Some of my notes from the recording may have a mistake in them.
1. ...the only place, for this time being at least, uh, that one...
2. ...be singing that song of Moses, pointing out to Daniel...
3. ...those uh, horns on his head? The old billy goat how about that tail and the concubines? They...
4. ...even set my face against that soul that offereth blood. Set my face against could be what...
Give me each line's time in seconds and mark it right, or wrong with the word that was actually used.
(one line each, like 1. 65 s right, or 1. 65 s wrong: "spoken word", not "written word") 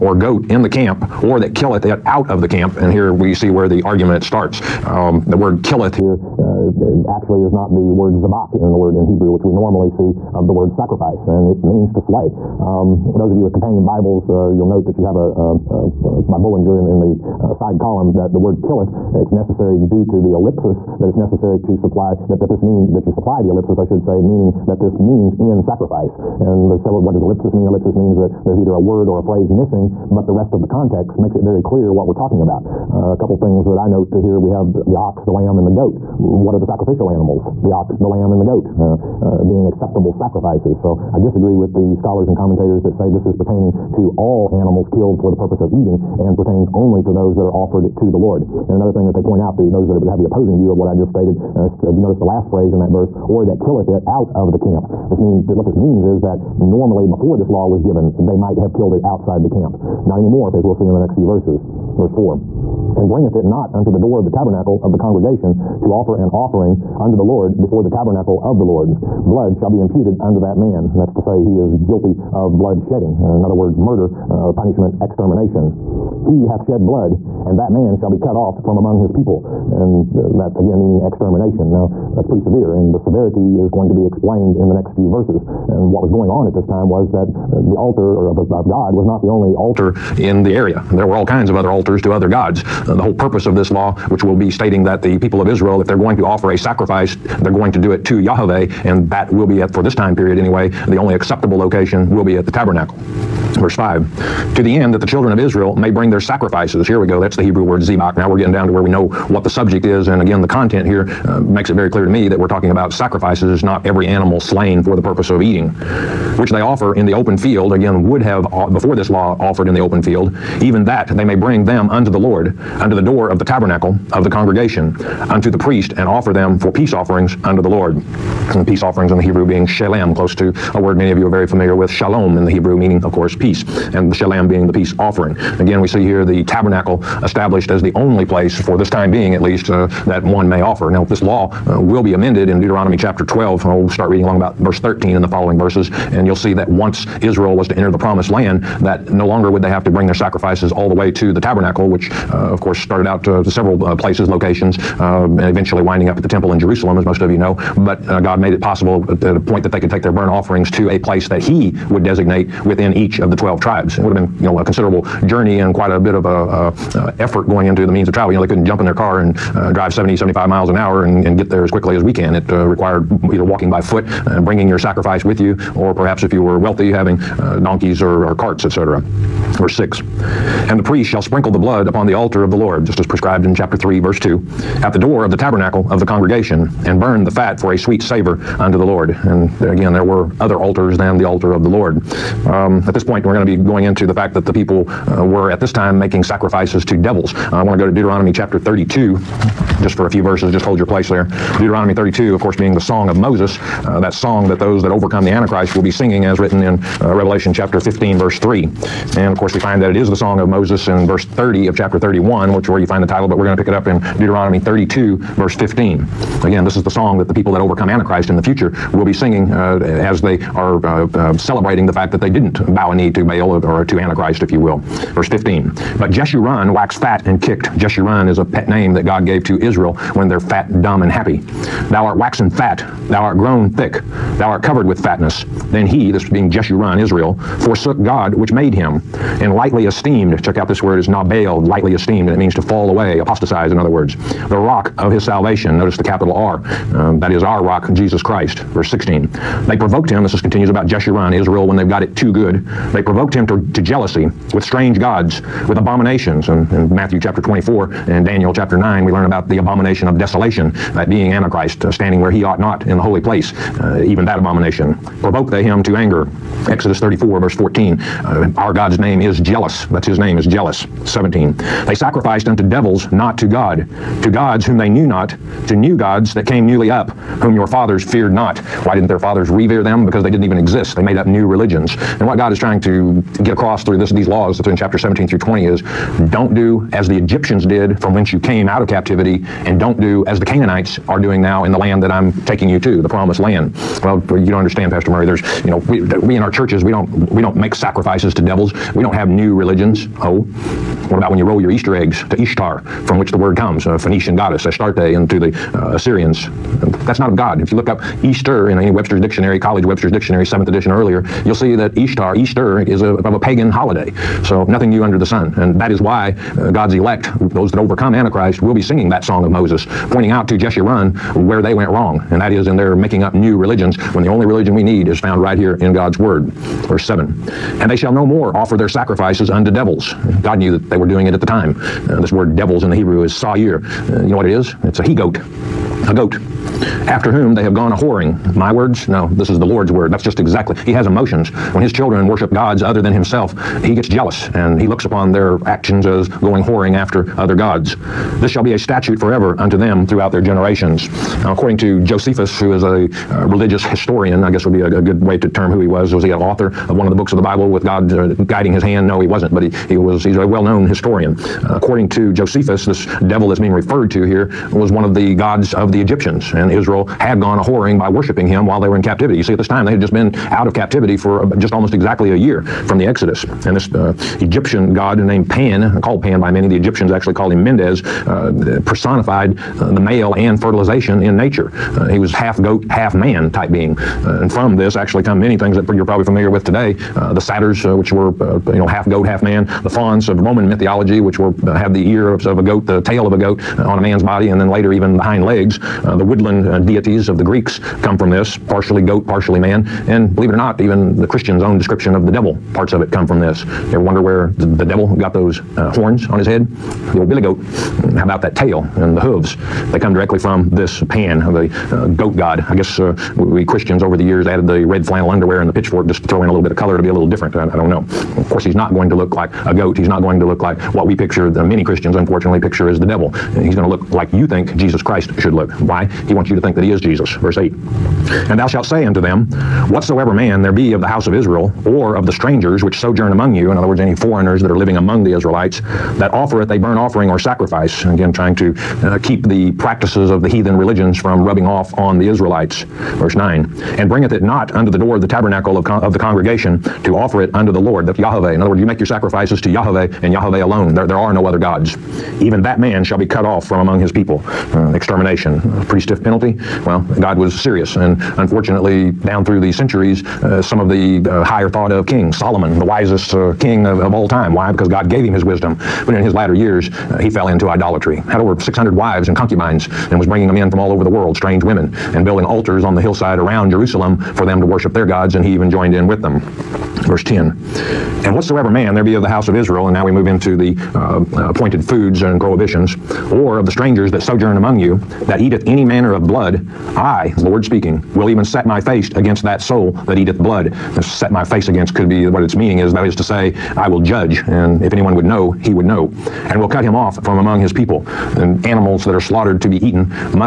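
1. 137 s right
2. 318 s wrong: "Jeshurun", not "Daniel"
3. 405 s wrong: "hooves", not "concubines"
4. 488 s wrong: "eateth", not "offereth".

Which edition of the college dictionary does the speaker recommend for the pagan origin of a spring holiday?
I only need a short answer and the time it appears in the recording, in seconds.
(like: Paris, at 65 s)
seventh edition, at 310 s.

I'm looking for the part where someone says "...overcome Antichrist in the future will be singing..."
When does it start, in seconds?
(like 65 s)
217 s.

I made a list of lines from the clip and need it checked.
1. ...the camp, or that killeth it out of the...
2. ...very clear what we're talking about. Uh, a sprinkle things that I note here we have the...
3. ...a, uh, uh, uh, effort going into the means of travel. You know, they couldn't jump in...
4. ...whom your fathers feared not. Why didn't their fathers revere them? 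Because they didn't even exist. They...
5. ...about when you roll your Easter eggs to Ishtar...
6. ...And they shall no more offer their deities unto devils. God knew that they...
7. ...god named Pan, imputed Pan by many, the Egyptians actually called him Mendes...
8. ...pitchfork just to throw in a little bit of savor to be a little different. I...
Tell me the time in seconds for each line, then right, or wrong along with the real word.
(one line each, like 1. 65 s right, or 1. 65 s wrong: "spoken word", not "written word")
1. 0 s right
2. 31 s wrong: "couple", not "sprinkle"
3. 166 s right
4. 277 s right
5. 301 s right
6. 327 s wrong: "sacrifices", not "deities"
7. 374 s wrong: "called", not "imputed"
8. 415 s wrong: "color", not "savor".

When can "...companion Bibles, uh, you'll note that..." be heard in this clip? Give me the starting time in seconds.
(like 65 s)
13 s.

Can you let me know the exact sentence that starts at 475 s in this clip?
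And he even joined in with with them.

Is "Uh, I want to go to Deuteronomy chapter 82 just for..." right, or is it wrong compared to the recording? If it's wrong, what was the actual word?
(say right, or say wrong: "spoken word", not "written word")
wrong: "32", not "82".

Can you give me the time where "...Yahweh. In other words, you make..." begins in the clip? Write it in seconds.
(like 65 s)
448 s.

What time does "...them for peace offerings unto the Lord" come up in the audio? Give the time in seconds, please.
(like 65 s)
126 s.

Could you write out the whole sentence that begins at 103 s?
Verse 5 to the end that the children of Israel may bring their sacrifices.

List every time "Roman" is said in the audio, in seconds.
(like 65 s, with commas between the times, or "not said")
390 s.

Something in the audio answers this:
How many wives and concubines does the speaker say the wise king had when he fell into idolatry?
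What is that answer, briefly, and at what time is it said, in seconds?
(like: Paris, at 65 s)
over 600, at 468 s.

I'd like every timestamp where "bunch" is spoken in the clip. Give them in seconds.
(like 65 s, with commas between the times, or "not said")
not said.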